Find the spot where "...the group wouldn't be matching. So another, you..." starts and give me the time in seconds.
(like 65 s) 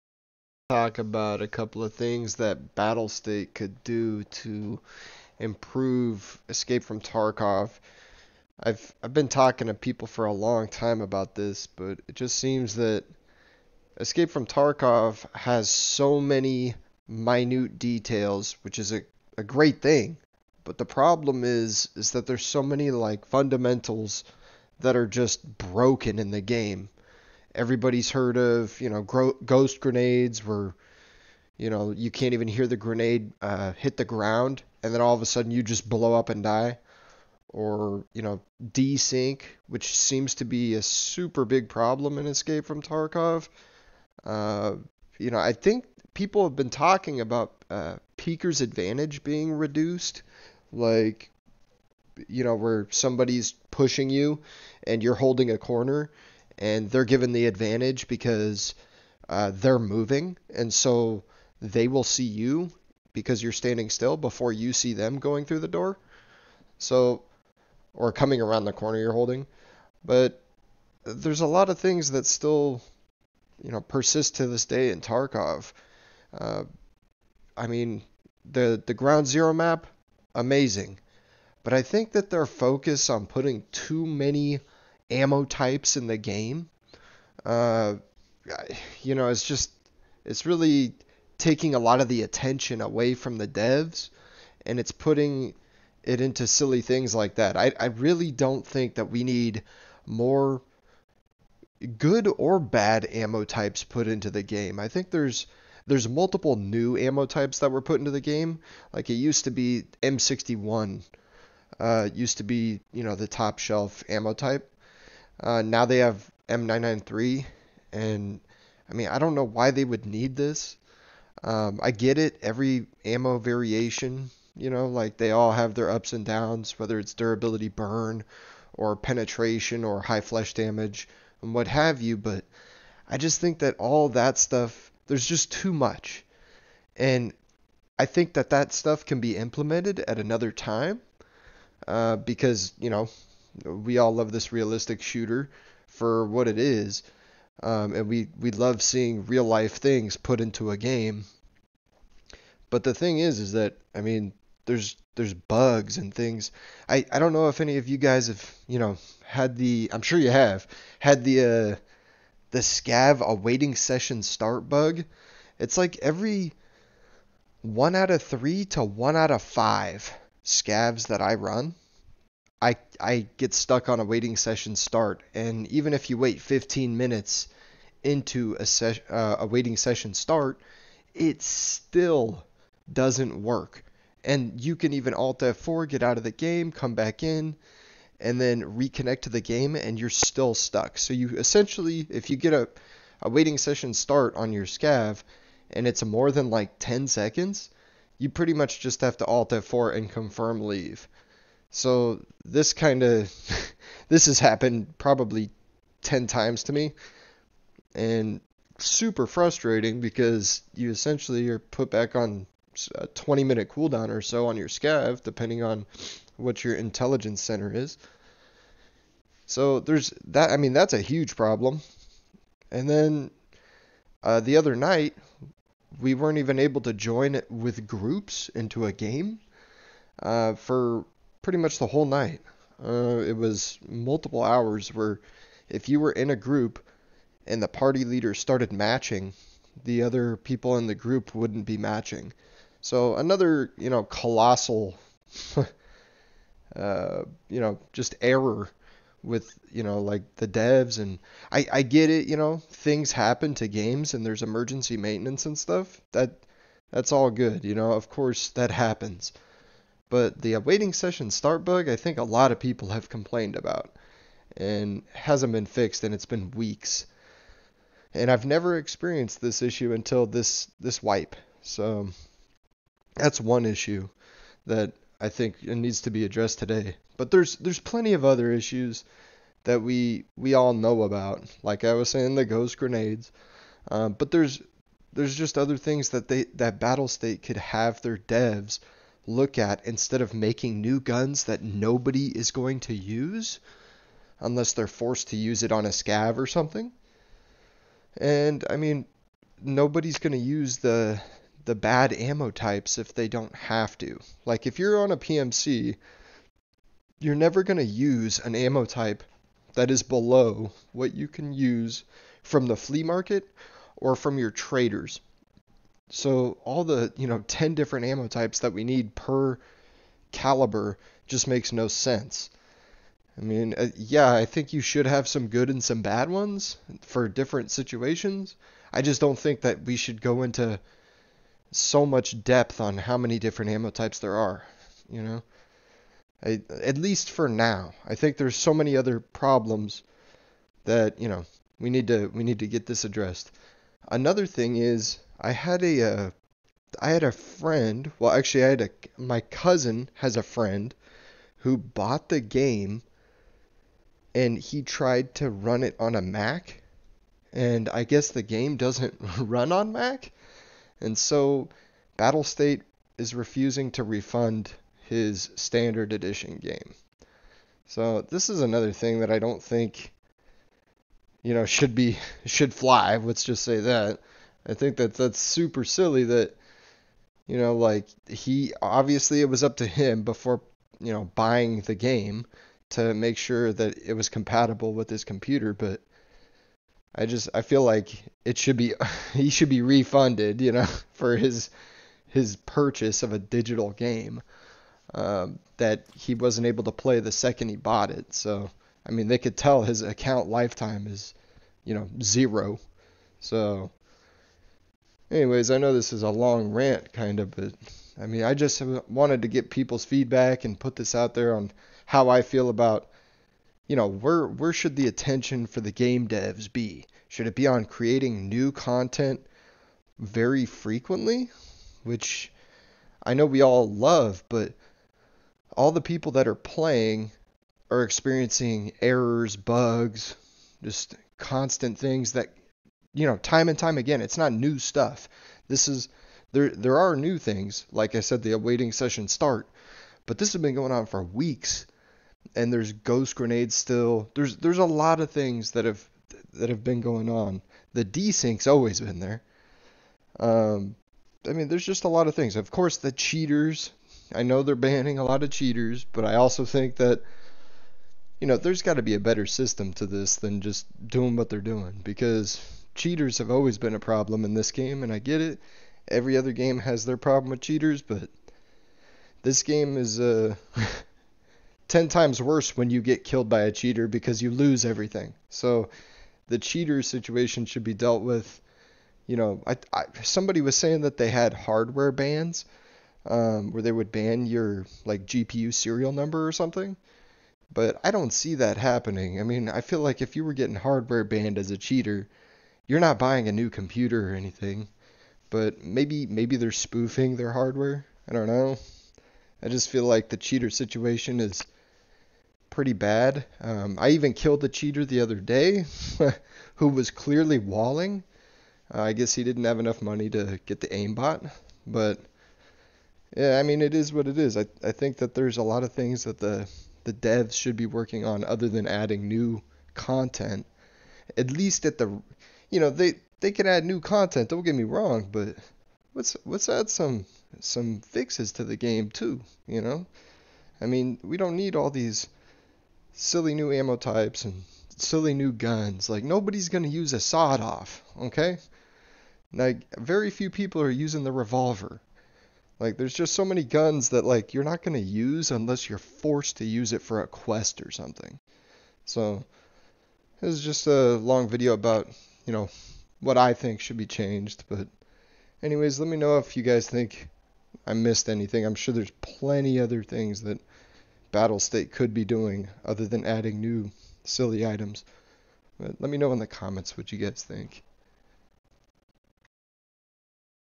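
240 s.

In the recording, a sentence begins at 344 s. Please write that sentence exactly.
Another thing is I had a, uh, I had a friend.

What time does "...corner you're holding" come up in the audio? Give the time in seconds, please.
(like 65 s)
68 s.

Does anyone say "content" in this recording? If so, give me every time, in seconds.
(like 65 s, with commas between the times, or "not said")
418 s, 519 s, 523 s.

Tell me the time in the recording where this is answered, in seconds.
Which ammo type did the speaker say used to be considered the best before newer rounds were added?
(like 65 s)
110 s.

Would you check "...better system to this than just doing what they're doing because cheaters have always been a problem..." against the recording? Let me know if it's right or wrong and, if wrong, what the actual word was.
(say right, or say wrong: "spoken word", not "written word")
right.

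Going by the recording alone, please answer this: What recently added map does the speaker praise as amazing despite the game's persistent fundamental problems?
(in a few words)
Ground Zero.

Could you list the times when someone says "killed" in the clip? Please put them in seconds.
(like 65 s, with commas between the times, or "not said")
473 s, 504 s.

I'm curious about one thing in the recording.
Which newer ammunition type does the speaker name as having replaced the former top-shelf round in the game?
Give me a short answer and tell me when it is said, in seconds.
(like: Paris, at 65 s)
M993, at 116 s.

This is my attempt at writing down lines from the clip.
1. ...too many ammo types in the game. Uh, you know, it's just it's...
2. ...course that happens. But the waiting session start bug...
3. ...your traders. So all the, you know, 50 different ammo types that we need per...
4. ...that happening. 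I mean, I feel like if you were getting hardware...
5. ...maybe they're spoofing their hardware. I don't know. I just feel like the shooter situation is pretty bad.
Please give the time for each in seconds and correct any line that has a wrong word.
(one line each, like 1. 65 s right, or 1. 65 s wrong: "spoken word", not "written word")
1. 83 s right
2. 258 s right
3. 314 s wrong: "10", not "50"
4. 488 s right
5. 496 s wrong: "cheater", not "shooter".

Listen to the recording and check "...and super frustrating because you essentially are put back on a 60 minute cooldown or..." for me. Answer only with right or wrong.
wrong.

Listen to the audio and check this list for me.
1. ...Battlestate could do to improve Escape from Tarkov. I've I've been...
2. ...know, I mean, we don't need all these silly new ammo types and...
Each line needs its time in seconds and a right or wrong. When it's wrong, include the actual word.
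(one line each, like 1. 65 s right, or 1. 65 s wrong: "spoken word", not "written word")
1. 2 s right
2. 529 s right.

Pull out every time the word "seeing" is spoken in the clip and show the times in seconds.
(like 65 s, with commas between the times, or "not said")
148 s.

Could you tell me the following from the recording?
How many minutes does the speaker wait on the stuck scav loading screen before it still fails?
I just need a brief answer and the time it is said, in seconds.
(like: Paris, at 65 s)
15 minutes, at 176 s.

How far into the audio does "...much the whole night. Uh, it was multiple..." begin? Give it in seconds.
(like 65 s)
231 s.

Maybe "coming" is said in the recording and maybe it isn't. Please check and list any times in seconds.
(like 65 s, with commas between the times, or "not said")
68 s.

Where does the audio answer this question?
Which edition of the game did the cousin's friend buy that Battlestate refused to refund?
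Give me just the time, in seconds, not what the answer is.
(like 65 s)
365 s.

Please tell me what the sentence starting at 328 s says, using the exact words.
I just don't think that we should go into so much depth on how many different ammo types there are, you know?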